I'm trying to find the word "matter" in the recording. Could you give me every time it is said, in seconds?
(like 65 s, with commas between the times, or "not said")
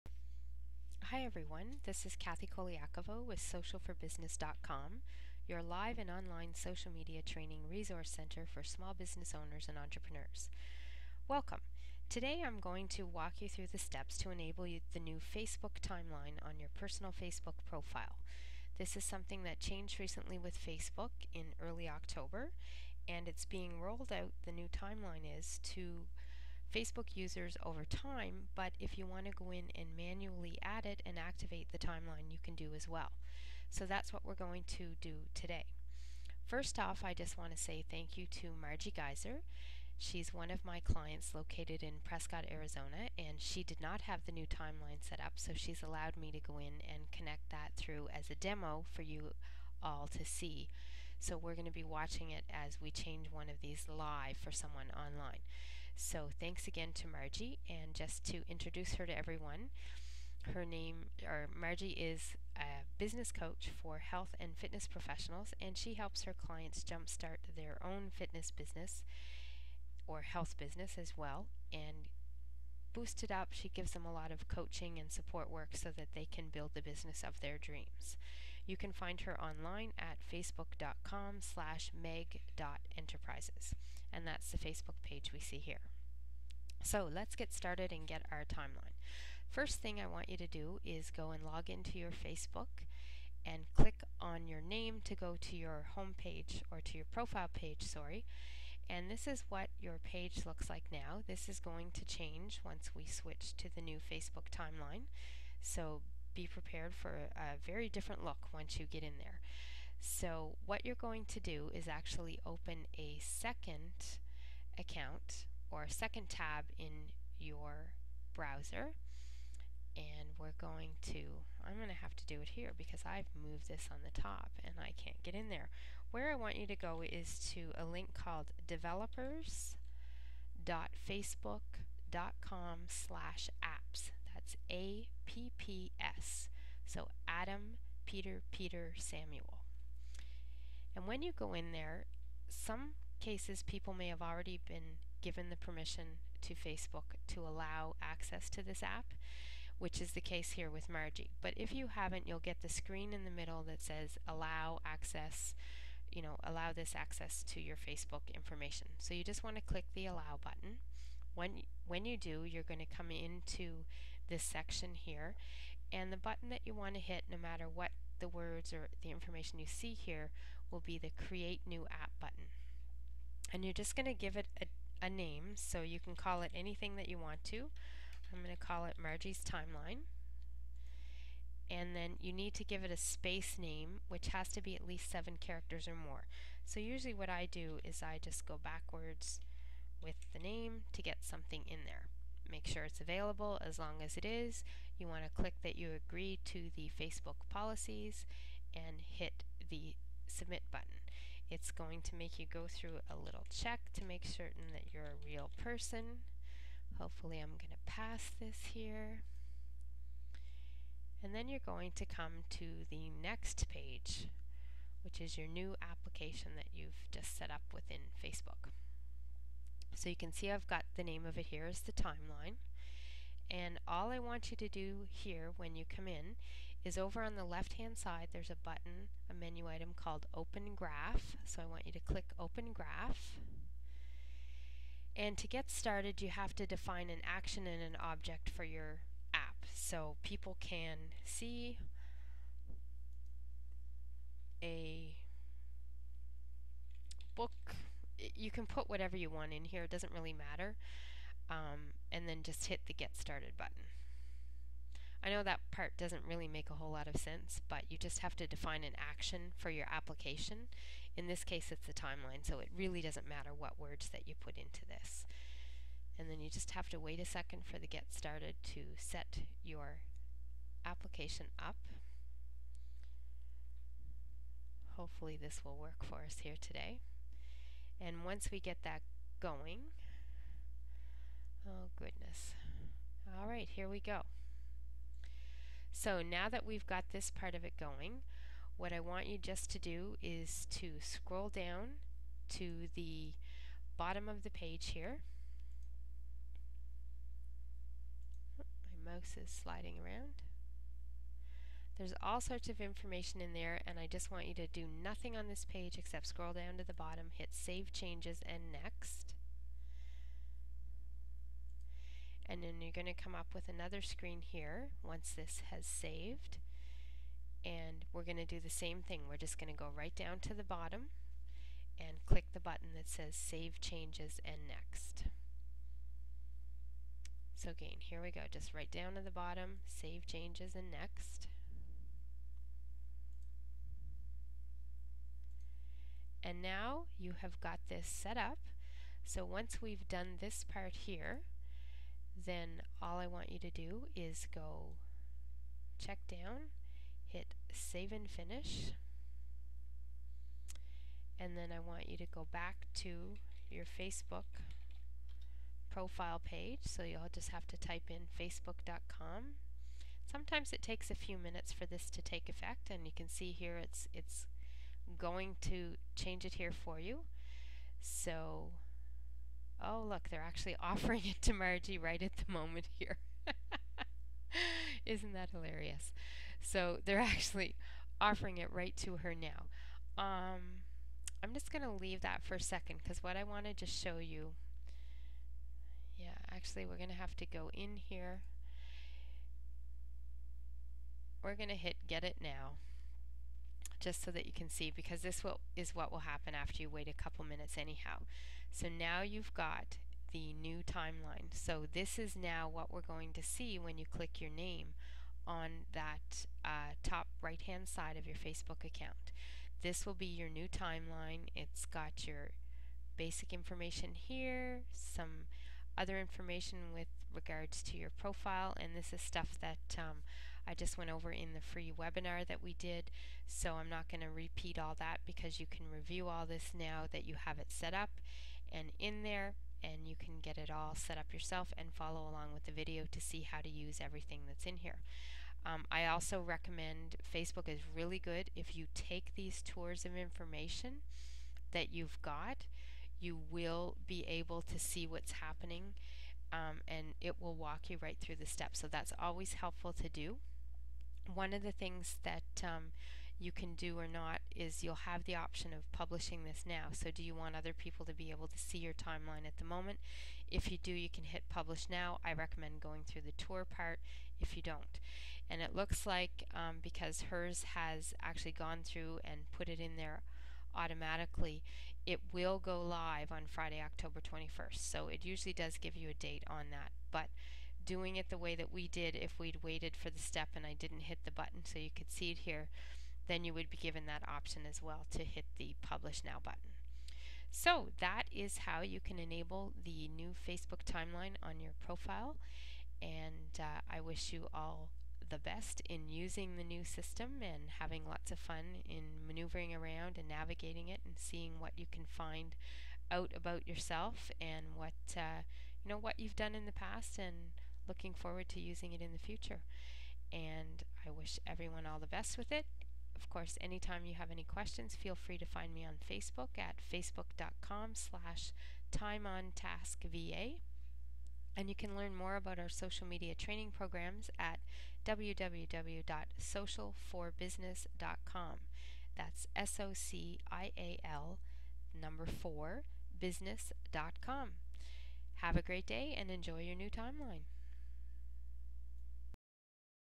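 167 s, 250 s, 263 s.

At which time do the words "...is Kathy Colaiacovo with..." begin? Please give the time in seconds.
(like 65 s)
2 s.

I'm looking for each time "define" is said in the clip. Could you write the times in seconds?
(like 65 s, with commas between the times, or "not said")
236 s, 258 s.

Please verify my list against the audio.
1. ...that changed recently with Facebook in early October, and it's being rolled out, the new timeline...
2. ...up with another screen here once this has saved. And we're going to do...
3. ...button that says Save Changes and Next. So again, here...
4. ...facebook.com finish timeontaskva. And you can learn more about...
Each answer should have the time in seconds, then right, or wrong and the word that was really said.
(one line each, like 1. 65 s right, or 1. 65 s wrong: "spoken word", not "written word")
1. 19 s right
2. 313 s right
3. 322 s right
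4. 516 s wrong: "slash", not "finish".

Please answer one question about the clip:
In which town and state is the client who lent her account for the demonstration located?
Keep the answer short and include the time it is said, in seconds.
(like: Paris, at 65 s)
Prescott, Arizona, at 42 s.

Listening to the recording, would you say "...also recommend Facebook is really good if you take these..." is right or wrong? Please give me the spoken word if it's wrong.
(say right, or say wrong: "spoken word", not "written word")
right.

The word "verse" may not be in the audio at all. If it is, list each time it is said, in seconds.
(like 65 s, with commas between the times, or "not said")
not said.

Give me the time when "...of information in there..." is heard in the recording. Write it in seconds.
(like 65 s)
302 s.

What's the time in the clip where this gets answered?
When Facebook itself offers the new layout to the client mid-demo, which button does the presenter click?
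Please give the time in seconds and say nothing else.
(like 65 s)
392 s.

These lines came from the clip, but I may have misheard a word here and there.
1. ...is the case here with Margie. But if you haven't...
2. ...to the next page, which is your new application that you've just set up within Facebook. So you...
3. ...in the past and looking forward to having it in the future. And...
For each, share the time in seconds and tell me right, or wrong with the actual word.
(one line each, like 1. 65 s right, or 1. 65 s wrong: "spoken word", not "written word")
1. 150 s right
2. 212 s right
3. 506 s wrong: "using", not "having".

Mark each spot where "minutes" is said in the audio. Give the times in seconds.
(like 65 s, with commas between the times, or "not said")
361 s, 397 s.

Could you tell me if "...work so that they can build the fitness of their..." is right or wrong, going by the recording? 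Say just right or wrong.
wrong.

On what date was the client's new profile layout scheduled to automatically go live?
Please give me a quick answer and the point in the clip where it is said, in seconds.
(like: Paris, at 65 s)
Friday, October 21st, at 473 s.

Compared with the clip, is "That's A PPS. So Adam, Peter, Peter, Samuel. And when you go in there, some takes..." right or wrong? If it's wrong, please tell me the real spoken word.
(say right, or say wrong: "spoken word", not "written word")
wrong: "cases", not "takes".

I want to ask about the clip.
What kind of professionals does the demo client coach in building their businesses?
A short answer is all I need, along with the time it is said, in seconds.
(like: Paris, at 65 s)
health and fitness professionals, at 63 s.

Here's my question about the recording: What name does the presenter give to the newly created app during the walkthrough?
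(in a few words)
Margie's timeline.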